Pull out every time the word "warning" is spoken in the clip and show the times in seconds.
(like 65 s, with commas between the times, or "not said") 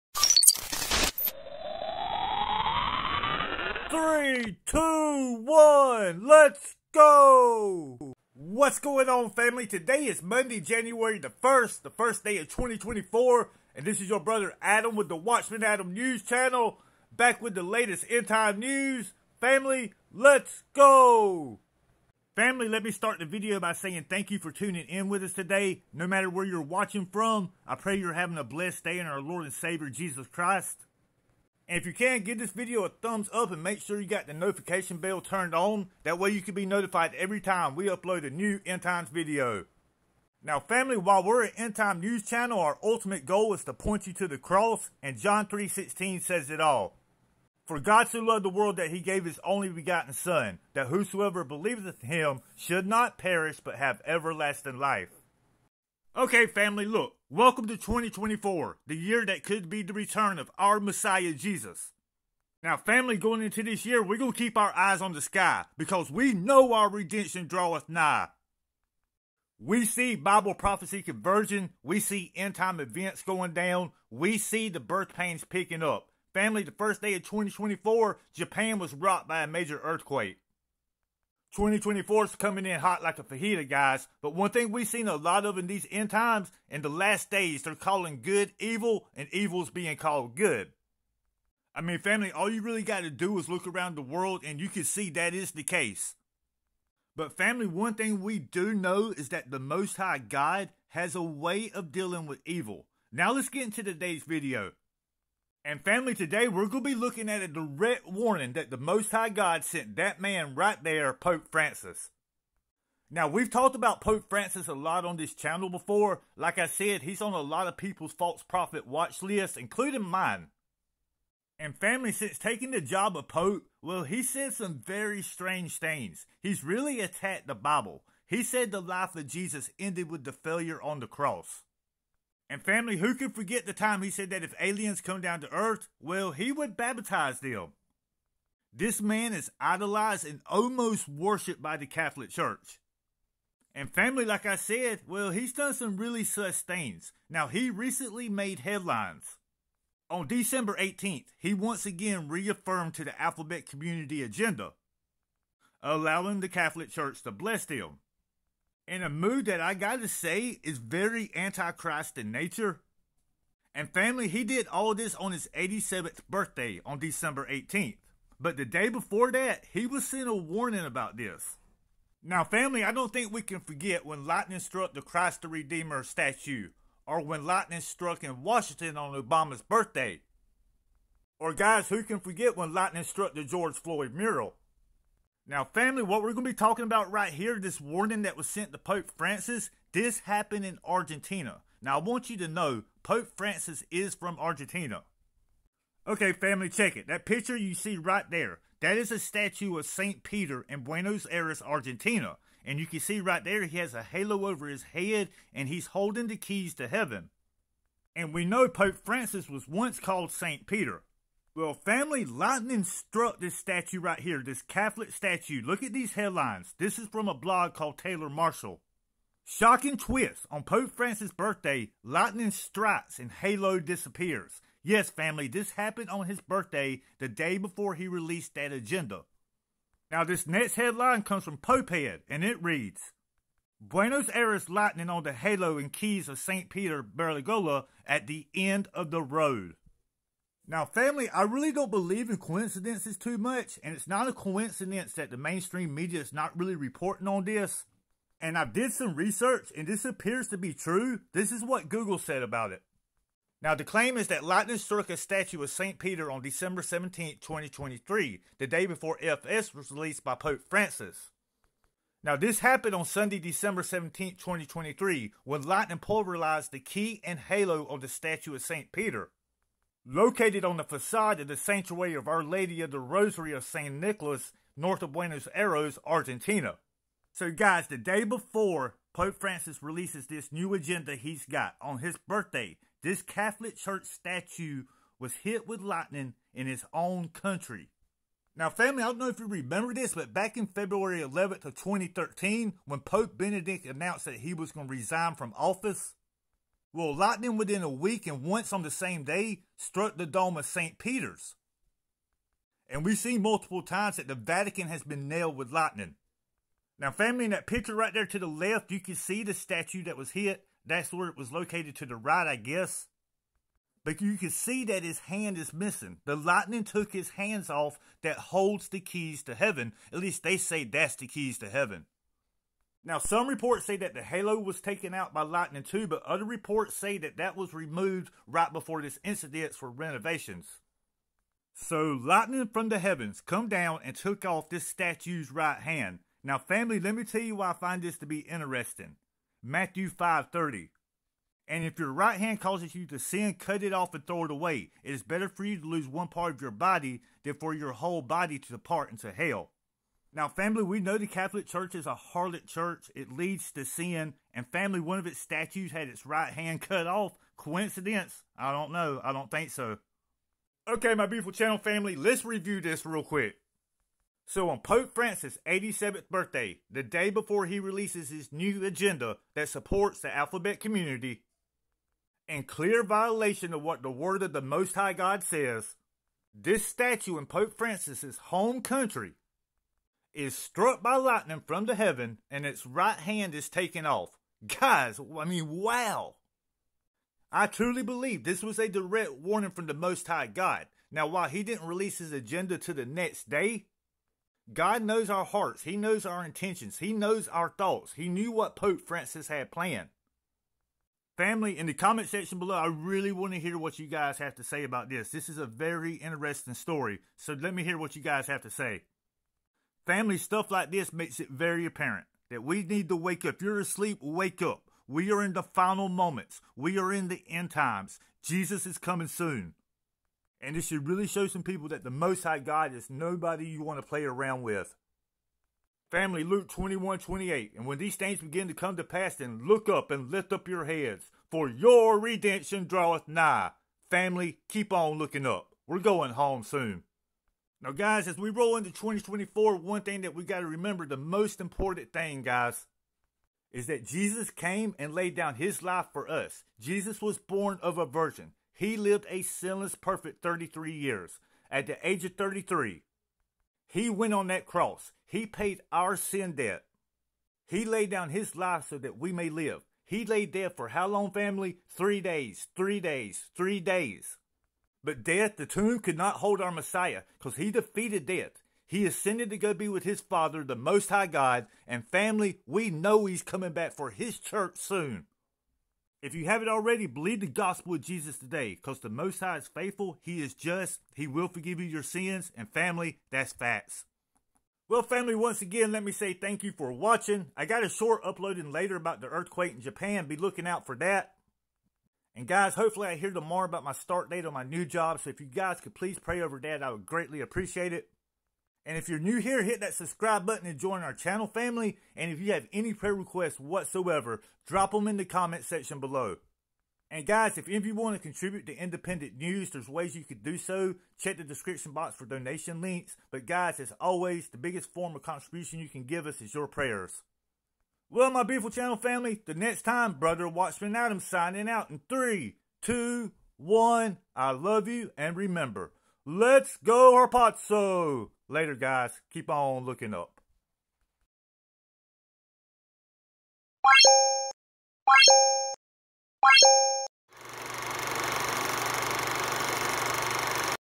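108 s, 170 s, 187 s, 389 s.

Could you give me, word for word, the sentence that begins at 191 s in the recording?
Now, I want you to know Pope Francis is from Argentina.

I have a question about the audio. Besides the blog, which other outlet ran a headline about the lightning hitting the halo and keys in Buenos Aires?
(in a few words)
Popehead.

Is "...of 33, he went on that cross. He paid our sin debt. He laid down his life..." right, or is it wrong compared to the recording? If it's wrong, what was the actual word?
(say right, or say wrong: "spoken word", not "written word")
right.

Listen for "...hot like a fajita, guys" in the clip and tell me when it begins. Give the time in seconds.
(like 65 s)
82 s.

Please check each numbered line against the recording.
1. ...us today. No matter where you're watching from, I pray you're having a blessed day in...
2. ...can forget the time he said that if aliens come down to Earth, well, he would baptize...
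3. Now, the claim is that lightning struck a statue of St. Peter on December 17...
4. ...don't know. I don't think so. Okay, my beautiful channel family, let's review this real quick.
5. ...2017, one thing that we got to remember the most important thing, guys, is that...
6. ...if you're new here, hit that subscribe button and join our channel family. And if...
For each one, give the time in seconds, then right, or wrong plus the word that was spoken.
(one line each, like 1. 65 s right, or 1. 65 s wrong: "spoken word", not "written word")
1. 25 s right
2. 133 s right
3. 253 s right
4. 358 s right
5. 438 s wrong: "2024", not "2017"
6. 498 s right.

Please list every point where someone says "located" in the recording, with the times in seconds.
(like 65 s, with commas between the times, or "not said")
270 s, 311 s.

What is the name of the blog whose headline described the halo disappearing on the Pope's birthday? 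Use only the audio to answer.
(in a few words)
Taylor Marshall.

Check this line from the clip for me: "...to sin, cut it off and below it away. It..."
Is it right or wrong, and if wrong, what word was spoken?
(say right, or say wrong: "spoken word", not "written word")
wrong: "throw", not "below".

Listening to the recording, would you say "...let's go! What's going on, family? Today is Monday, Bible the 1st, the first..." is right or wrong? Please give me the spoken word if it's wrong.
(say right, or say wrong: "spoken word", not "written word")
wrong: "January", not "Bible".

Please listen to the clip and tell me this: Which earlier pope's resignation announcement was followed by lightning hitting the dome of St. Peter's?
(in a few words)
Pope Benedict.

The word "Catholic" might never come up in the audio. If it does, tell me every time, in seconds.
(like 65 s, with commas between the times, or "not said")
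141 s, 156 s, 214 s, 283 s, 351 s.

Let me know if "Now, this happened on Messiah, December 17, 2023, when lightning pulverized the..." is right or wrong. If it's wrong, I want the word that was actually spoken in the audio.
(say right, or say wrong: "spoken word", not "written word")
wrong: "Sunday", not "Messiah".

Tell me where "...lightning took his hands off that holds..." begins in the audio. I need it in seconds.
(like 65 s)
316 s.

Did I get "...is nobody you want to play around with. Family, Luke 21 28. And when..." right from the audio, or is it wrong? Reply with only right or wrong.
right.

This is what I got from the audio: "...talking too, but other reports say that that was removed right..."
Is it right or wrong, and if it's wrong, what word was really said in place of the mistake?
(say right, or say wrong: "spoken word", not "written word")
wrong: "lightning", not "talking".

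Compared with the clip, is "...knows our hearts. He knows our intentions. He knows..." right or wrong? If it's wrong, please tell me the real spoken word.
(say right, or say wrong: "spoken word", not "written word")
right.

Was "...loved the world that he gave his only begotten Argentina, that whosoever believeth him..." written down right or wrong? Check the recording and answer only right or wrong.
wrong.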